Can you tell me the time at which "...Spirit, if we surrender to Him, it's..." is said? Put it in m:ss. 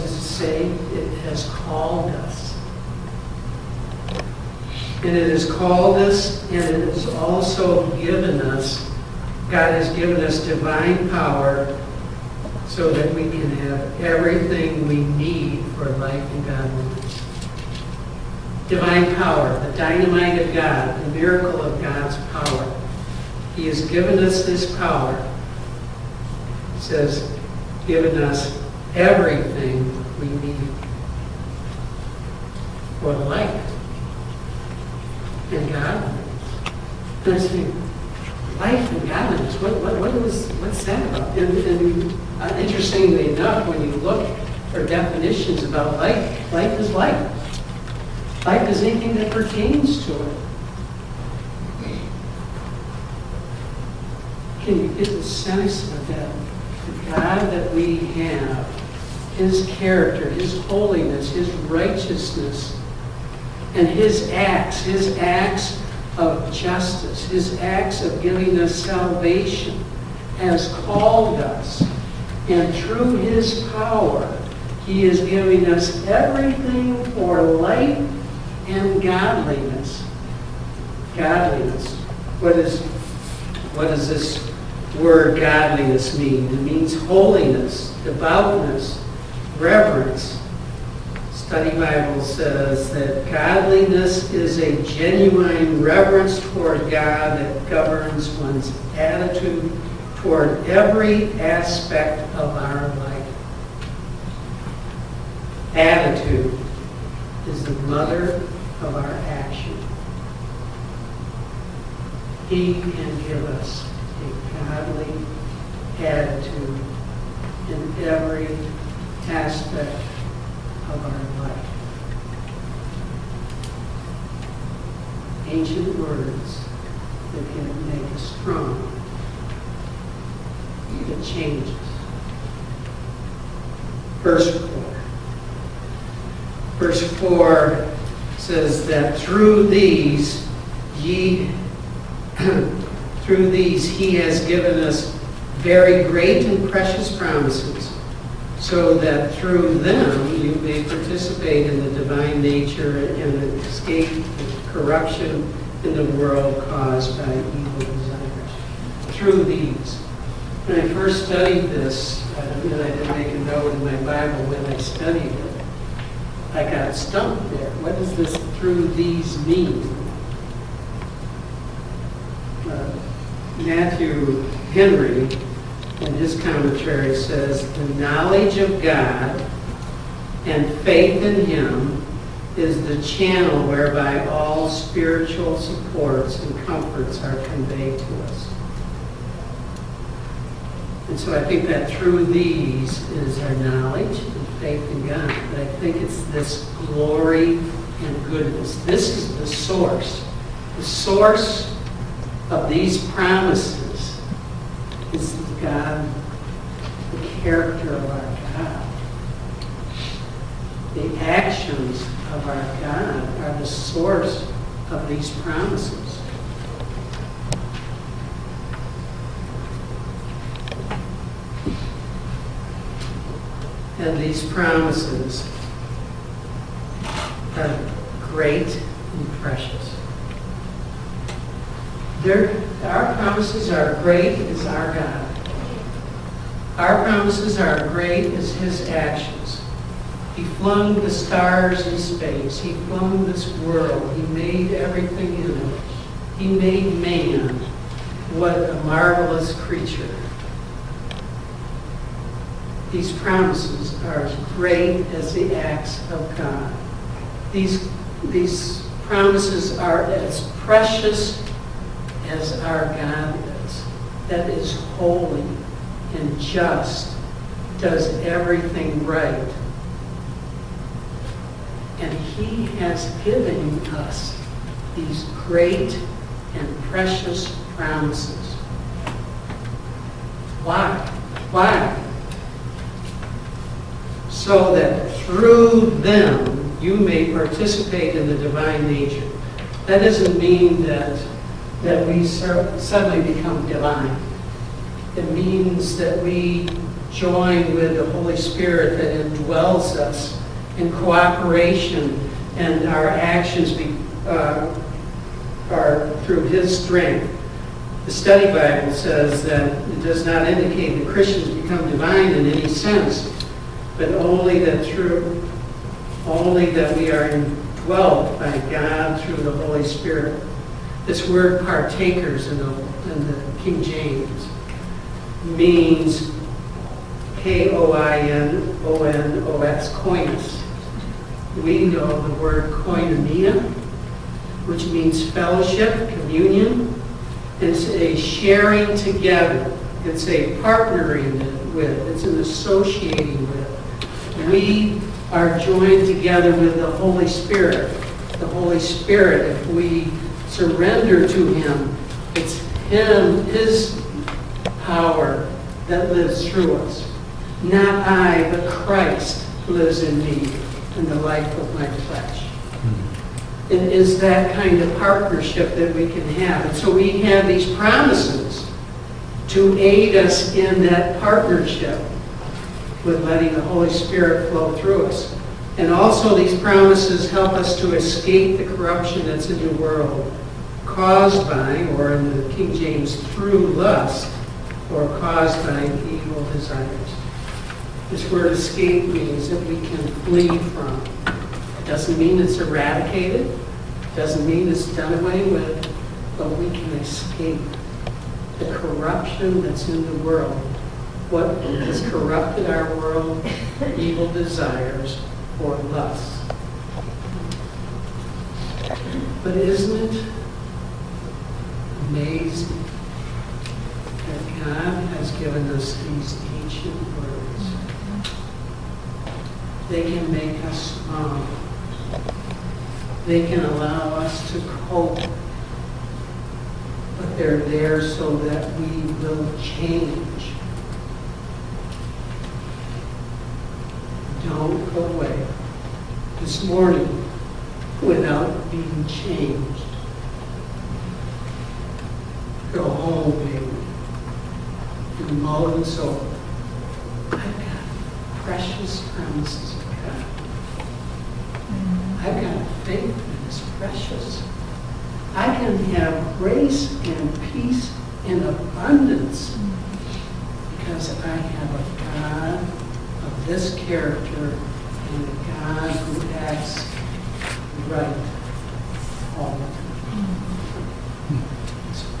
5:48.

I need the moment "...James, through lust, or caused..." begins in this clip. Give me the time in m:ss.
6:22.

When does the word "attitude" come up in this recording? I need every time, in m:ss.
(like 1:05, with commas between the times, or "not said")
1:38, 1:45, 1:56.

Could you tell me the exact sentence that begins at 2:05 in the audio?
Ancient words that can make us strong, even change us.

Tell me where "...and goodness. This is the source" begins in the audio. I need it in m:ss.
3:17.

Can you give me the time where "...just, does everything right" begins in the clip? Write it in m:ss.
4:26.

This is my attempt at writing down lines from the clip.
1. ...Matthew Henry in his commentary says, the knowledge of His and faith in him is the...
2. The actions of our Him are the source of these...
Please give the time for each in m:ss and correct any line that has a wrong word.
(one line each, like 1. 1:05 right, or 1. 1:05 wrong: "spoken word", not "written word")
1. 2:53 wrong: "God", not "His"
2. 3:30 wrong: "God", not "Him".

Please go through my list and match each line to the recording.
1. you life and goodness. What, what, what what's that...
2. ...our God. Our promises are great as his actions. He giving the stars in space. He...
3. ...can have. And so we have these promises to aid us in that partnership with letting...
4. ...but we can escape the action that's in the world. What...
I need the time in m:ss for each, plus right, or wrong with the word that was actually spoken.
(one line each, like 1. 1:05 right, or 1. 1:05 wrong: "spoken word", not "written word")
1. 0:37 wrong: "godliness", not "goodness"
2. 3:54 wrong: "flung", not "giving"
3. 6:06 right
4. 6:36 wrong: "corruption", not "action".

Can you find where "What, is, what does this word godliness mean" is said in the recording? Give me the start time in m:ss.
1:22.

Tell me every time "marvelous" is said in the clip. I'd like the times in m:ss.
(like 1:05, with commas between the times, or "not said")
4:08.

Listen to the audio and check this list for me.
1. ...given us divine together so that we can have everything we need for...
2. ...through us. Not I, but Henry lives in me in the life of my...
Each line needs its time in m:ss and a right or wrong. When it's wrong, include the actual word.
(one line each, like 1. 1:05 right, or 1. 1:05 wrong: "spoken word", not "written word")
1. 0:09 wrong: "power", not "together"
2. 5:56 wrong: "Christ", not "Henry".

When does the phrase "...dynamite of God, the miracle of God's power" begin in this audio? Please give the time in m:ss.
0:19.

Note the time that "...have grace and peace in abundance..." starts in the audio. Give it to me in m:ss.
7:35.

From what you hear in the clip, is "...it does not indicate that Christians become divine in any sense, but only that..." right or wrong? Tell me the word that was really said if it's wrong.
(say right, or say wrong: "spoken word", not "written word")
right.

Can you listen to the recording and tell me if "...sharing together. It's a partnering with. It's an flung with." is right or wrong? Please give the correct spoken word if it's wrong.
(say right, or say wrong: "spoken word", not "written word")
wrong: "associating", not "flung".